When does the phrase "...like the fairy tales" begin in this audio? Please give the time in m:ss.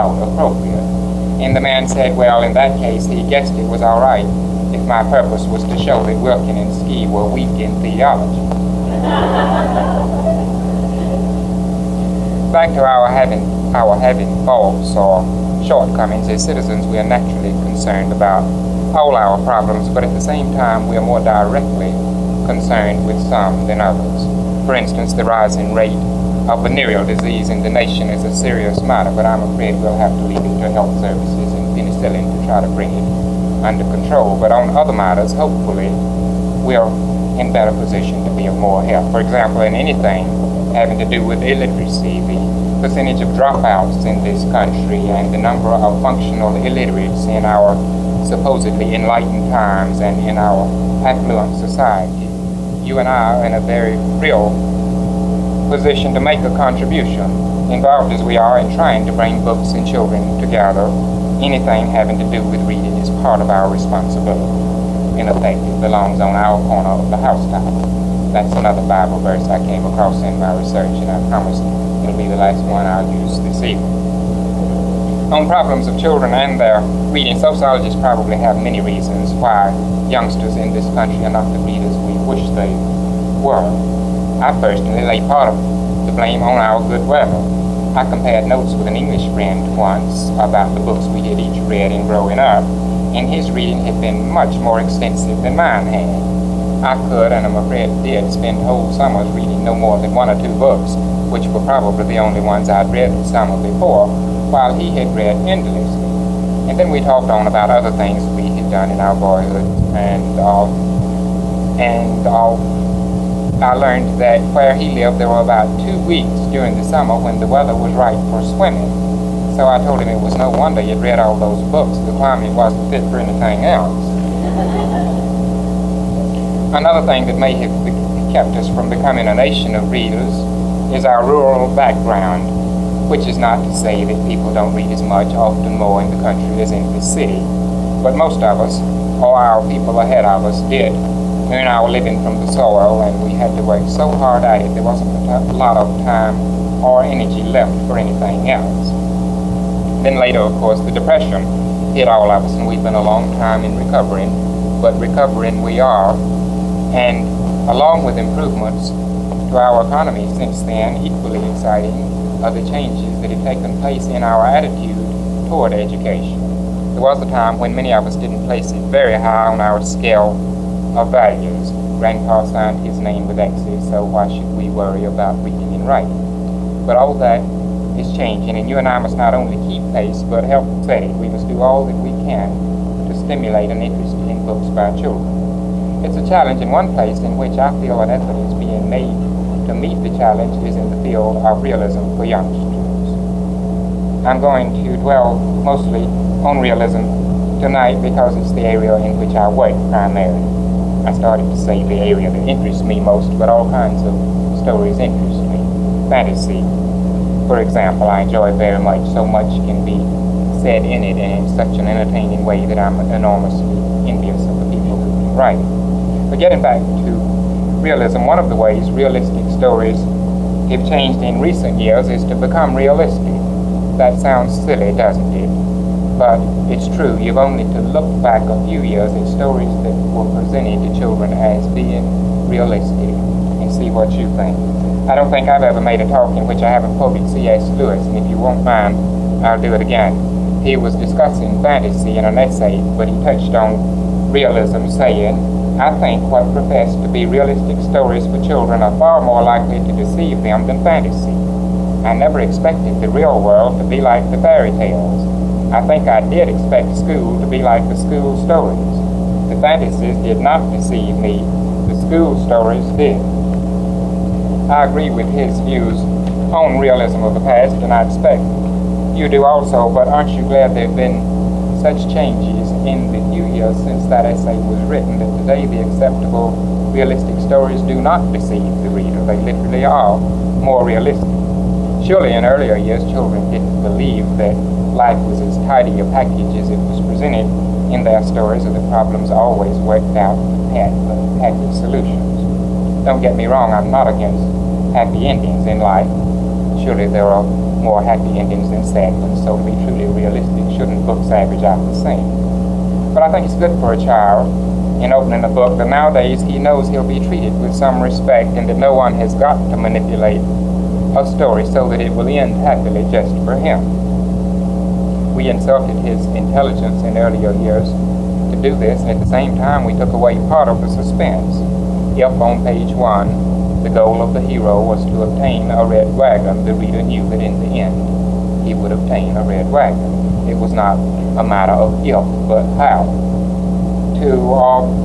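4:14.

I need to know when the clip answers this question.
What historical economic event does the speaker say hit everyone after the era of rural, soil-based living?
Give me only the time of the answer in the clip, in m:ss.
2:30.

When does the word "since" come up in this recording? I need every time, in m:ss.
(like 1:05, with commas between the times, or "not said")
2:40, 4:33.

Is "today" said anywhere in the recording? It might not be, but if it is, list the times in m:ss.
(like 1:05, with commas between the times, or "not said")
4:35.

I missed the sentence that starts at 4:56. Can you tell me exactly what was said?
Surely there are more happy endings than sad ones, so to be truly realistic, shouldn't books average out the same?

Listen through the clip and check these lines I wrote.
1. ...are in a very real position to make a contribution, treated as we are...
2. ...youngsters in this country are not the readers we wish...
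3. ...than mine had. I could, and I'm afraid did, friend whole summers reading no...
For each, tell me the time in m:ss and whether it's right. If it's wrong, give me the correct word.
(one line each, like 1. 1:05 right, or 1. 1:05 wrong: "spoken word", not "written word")
1. 0:53 wrong: "involved", not "treated"
2. 1:20 right
3. 1:35 wrong: "spend", not "friend".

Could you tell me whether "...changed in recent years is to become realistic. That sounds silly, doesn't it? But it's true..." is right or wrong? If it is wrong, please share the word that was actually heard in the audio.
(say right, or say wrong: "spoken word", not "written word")
right.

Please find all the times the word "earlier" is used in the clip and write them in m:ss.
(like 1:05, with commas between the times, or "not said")
4:42, 5:17.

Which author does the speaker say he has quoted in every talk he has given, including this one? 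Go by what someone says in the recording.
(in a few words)
C.S. Lewis.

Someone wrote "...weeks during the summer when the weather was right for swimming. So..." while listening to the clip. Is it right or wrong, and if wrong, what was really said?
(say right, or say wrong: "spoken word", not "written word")
right.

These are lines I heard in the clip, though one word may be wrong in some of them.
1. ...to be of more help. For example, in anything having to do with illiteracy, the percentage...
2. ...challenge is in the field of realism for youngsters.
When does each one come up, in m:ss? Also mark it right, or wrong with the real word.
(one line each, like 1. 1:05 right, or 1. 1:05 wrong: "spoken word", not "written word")
1. 0:38 right
2. 3:10 right.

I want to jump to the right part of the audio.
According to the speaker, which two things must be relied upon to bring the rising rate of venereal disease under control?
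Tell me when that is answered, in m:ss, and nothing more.
0:30.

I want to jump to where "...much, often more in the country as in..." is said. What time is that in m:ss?
2:15.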